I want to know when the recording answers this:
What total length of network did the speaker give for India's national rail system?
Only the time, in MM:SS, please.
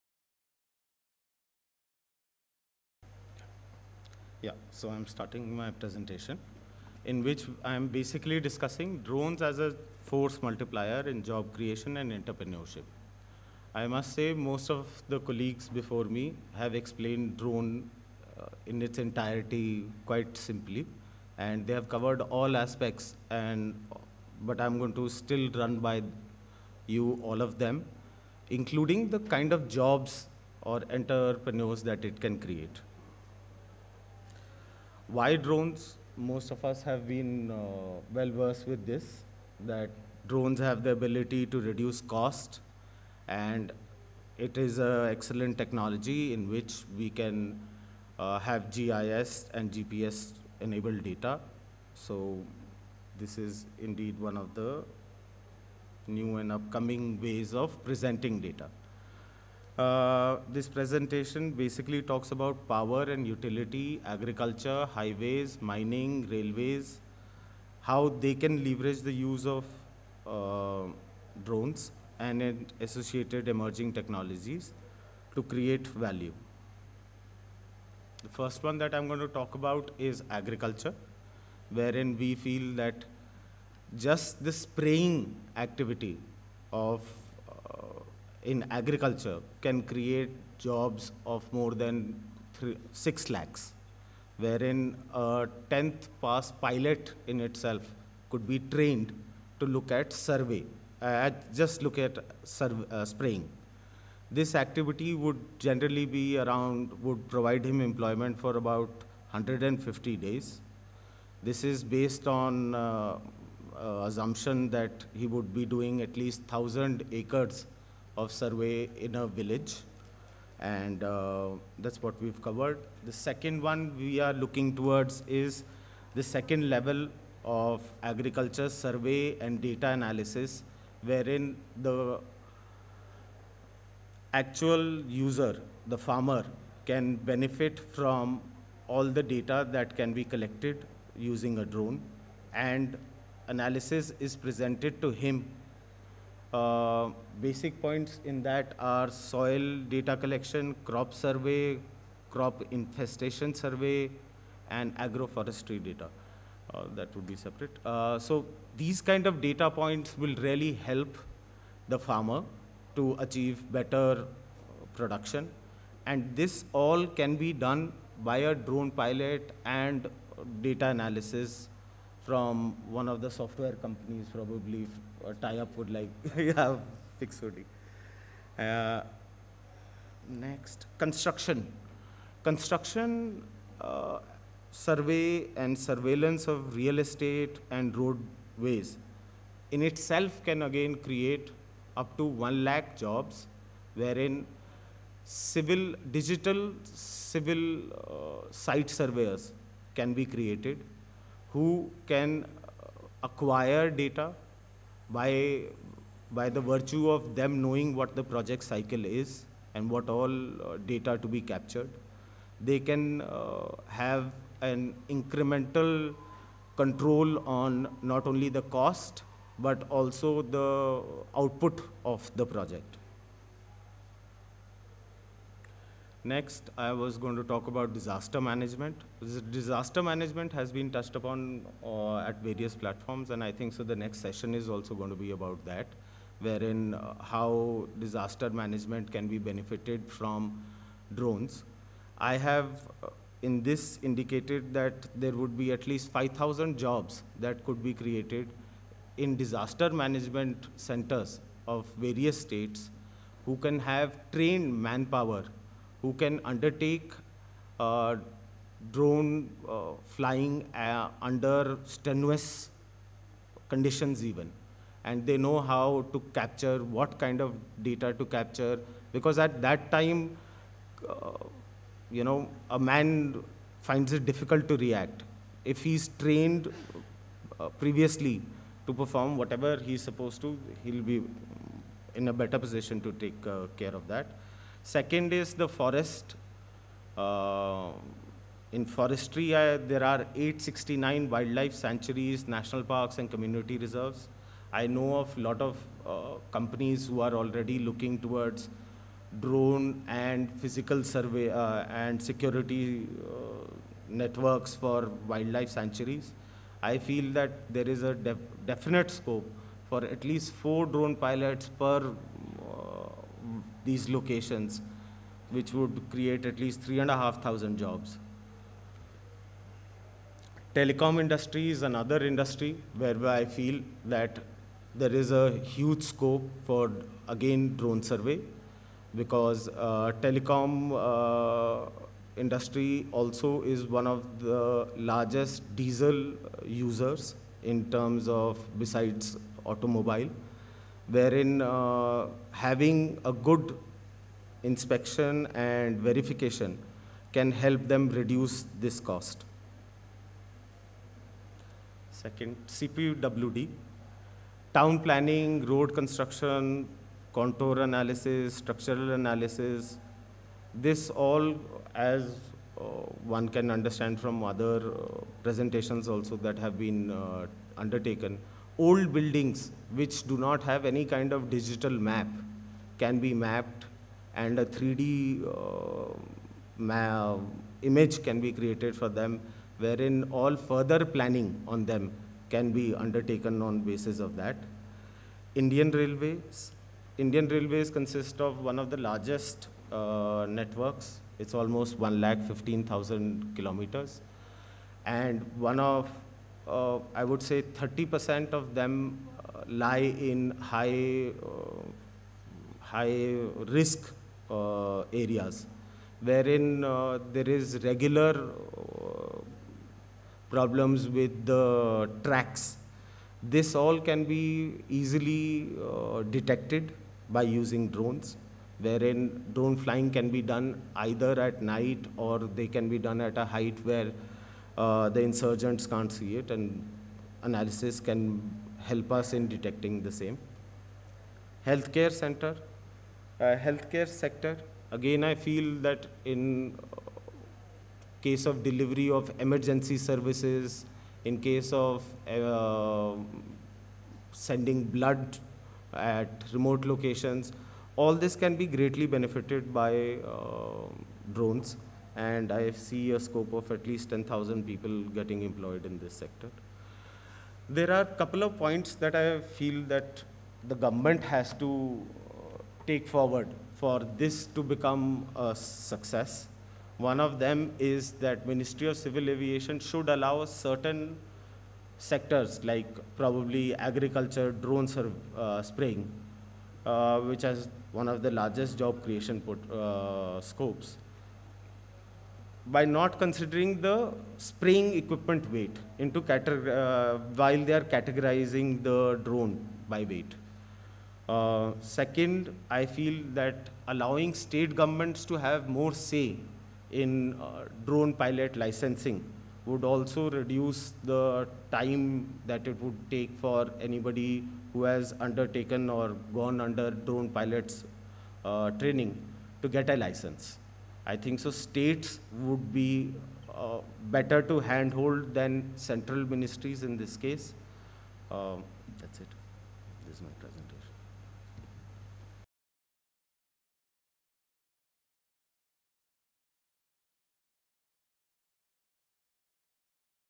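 06:31.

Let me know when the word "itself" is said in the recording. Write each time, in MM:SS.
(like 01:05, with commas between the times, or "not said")
01:37, 03:09.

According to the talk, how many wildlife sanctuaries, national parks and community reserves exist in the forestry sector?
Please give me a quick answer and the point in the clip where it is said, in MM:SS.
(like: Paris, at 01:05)
869, at 04:50.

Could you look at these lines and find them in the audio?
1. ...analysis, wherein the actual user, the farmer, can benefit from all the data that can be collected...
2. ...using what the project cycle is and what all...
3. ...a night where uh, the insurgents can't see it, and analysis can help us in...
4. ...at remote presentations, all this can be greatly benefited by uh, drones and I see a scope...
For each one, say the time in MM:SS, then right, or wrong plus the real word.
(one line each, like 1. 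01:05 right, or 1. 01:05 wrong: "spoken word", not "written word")
1. 02:09 right
2. 03:27 wrong: "knowing", not "using"
3. 07:03 wrong: "height", not "night"
4. 07:25 wrong: "locations", not "presentations".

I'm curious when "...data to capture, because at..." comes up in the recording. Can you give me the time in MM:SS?
04:27.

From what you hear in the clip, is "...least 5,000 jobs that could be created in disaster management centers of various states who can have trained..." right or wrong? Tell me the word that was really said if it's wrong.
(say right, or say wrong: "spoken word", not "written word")
right.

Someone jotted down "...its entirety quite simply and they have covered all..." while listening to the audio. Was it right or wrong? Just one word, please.
right.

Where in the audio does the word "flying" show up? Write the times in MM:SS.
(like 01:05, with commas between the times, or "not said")
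04:20, 06:59.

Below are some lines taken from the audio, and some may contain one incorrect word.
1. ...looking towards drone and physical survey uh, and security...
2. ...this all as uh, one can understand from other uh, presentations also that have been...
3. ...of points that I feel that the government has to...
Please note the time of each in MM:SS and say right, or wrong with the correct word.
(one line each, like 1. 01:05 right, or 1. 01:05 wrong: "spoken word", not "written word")
1. 04:57 right
2. 06:00 right
3. 07:38 right.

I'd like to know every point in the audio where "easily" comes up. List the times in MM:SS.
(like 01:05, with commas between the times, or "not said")
06:54.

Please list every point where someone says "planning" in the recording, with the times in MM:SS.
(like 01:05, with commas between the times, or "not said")
05:54, 06:21.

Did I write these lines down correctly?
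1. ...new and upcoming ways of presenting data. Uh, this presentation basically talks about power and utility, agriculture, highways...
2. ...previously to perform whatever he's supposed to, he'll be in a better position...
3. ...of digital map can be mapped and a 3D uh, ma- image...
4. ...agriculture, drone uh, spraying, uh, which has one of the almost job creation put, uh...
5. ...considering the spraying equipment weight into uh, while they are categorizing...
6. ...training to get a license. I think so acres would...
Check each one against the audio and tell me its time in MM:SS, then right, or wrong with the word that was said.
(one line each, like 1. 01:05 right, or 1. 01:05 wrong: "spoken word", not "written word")
1. 00:56 right
2. 04:37 right
3. 06:11 right
4. 07:53 wrong: "largest", not "almost"
5. 08:03 right
6. 08:28 wrong: "states", not "acres".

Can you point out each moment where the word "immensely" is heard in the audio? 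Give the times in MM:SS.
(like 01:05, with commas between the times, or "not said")
not said.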